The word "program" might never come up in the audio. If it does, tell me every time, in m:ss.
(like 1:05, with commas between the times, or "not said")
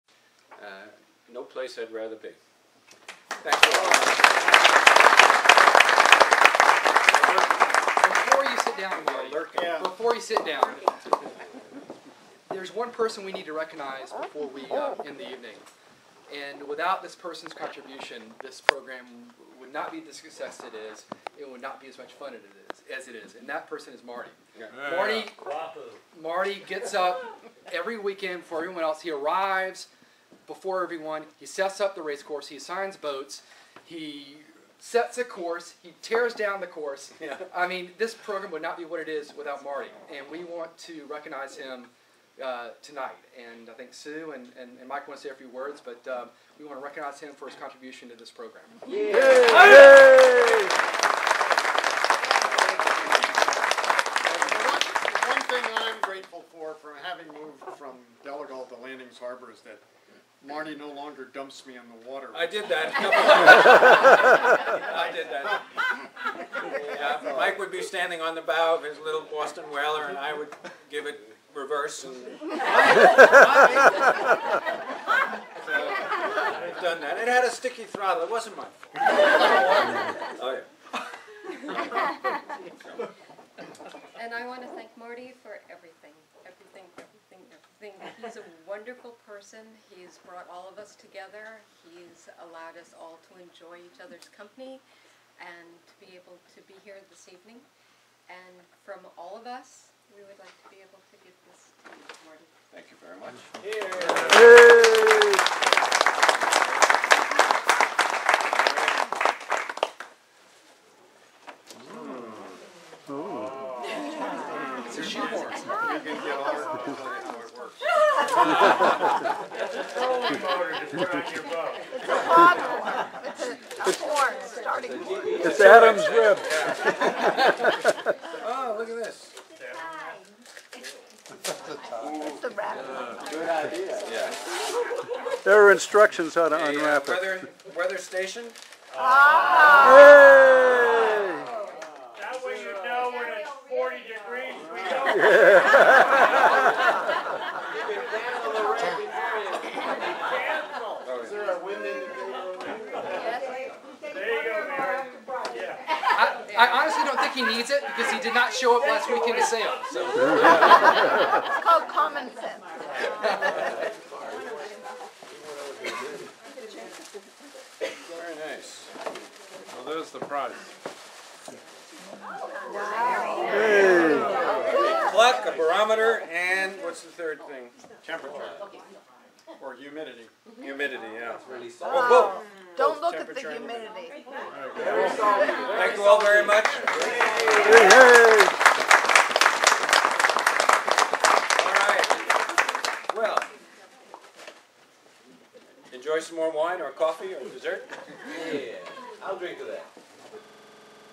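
0:18, 0:38, 0:48.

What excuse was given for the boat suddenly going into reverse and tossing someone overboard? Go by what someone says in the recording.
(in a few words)
A sticky throttle.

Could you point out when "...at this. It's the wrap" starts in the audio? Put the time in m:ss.
2:08.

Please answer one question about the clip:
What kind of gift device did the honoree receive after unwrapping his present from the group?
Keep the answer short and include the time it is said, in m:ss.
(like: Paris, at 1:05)
Weather station, at 2:17.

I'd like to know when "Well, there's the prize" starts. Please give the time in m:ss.
2:49.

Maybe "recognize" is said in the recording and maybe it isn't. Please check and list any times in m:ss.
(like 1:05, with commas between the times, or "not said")
0:13, 0:41, 0:46.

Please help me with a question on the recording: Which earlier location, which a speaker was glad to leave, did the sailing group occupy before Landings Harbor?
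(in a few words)
Delegal.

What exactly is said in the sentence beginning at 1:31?
He's allowed us all to enjoy each other's company and to be able to be here this evening.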